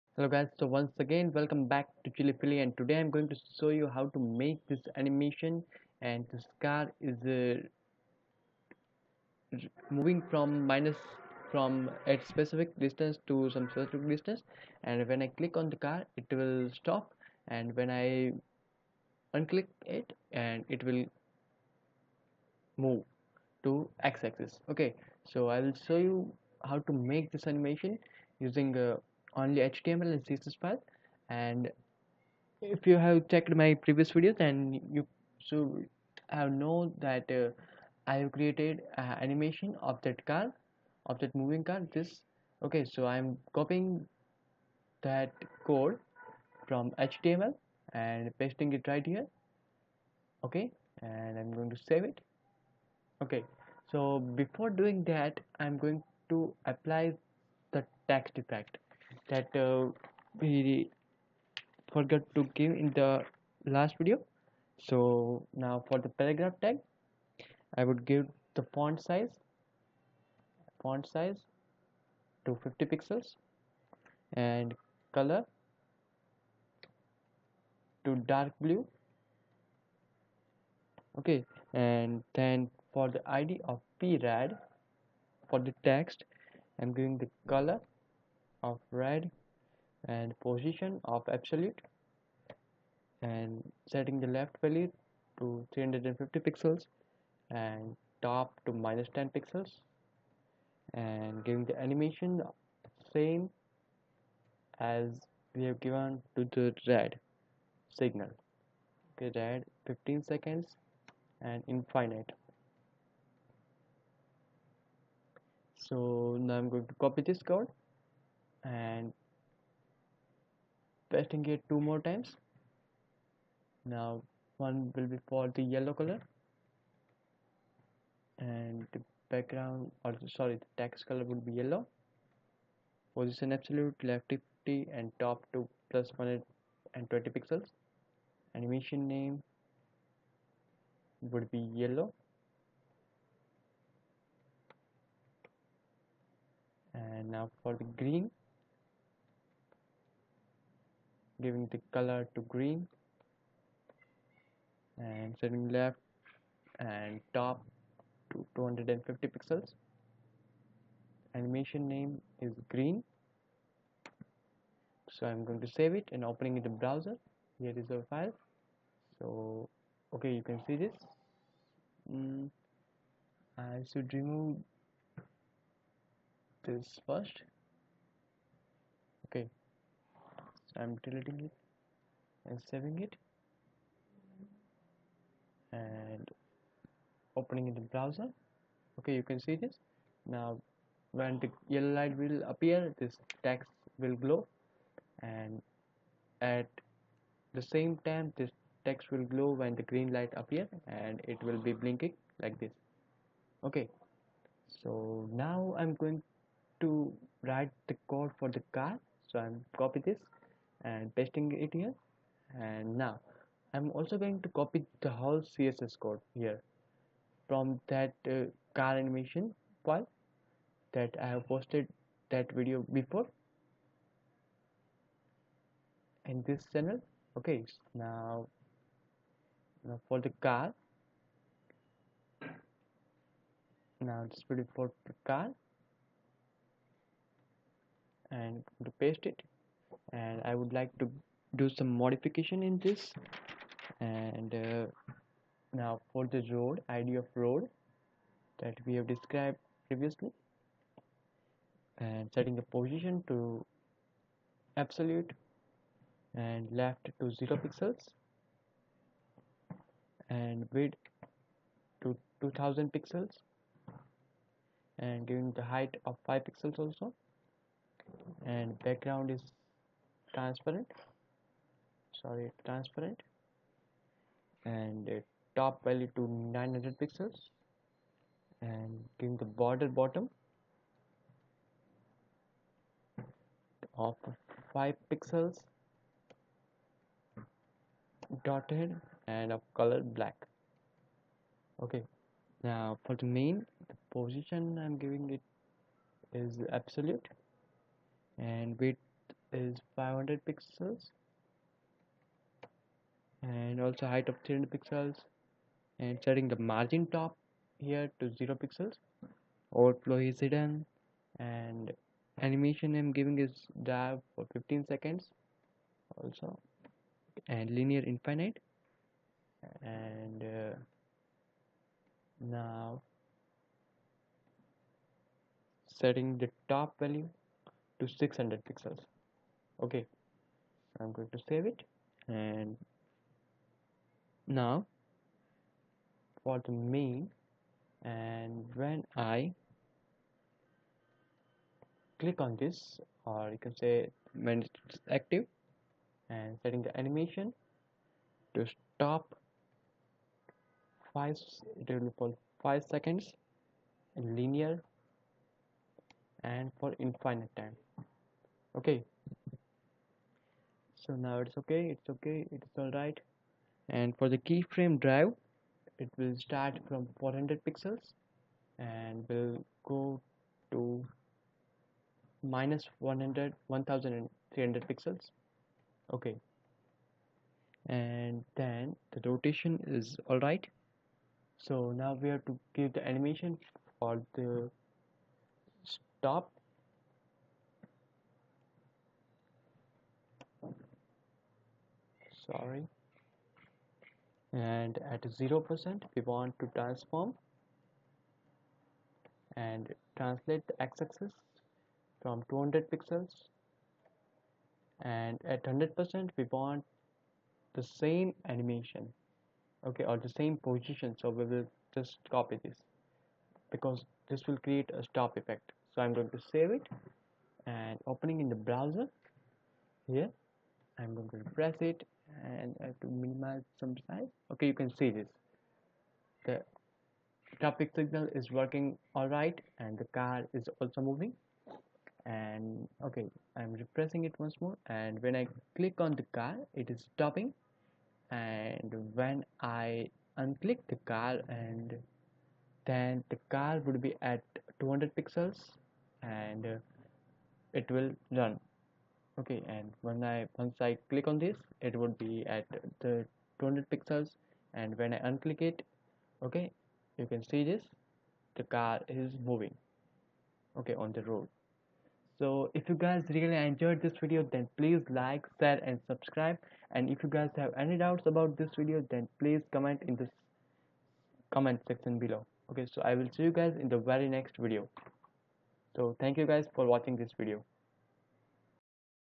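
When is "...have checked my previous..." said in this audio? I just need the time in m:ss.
0:32.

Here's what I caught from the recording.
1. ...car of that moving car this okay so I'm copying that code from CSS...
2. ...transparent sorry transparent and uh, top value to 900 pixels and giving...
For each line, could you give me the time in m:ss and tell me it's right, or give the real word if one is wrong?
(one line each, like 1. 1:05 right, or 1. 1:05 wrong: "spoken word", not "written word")
1. 0:40 wrong: "HTML", not "CSS"
2. 4:30 right.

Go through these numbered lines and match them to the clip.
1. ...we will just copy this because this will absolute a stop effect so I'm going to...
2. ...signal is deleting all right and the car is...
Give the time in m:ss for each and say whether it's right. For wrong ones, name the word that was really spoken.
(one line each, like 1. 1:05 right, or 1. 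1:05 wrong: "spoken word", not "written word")
1. 6:51 wrong: "create", not "absolute"
2. 7:07 wrong: "working", not "deleting".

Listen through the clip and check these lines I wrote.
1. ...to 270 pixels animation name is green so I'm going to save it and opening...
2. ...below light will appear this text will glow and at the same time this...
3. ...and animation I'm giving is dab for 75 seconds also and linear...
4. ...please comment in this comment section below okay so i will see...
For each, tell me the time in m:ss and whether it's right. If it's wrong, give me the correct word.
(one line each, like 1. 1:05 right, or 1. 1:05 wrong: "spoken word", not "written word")
1. 2:38 wrong: "250", not "270"
2. 3:11 wrong: "yellow", not "below"
3. 5:11 wrong: "15", not "75"
4. 7:49 right.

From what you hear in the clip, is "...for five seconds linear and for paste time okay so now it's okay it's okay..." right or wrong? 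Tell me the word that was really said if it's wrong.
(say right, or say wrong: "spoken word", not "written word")
wrong: "infinite", not "paste".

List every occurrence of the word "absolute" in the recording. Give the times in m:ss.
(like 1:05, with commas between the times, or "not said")
1:31, 2:13, 4:14, 4:56.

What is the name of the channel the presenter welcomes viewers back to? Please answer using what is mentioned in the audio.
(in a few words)
ChillyFilly.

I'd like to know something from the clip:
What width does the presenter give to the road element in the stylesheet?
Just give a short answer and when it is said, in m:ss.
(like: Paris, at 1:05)
2000 pixels, at 4:22.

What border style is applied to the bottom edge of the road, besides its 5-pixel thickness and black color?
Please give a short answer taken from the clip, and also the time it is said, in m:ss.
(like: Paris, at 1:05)
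dotted, at 4:48.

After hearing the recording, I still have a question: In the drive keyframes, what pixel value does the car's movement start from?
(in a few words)
400 pixels.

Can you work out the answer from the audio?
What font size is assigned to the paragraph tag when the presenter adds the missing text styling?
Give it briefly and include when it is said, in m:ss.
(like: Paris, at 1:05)
50 pixels, at 1:12.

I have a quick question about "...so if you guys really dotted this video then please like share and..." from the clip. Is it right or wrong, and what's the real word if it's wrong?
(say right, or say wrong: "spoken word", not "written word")
wrong: "enjoyed", not "dotted".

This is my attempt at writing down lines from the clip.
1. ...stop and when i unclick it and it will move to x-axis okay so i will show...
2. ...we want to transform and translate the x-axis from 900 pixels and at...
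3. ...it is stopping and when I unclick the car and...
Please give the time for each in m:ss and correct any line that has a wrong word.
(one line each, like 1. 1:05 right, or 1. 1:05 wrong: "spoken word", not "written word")
1. 0:16 right
2. 6:36 wrong: "200", not "900"
3. 7:16 right.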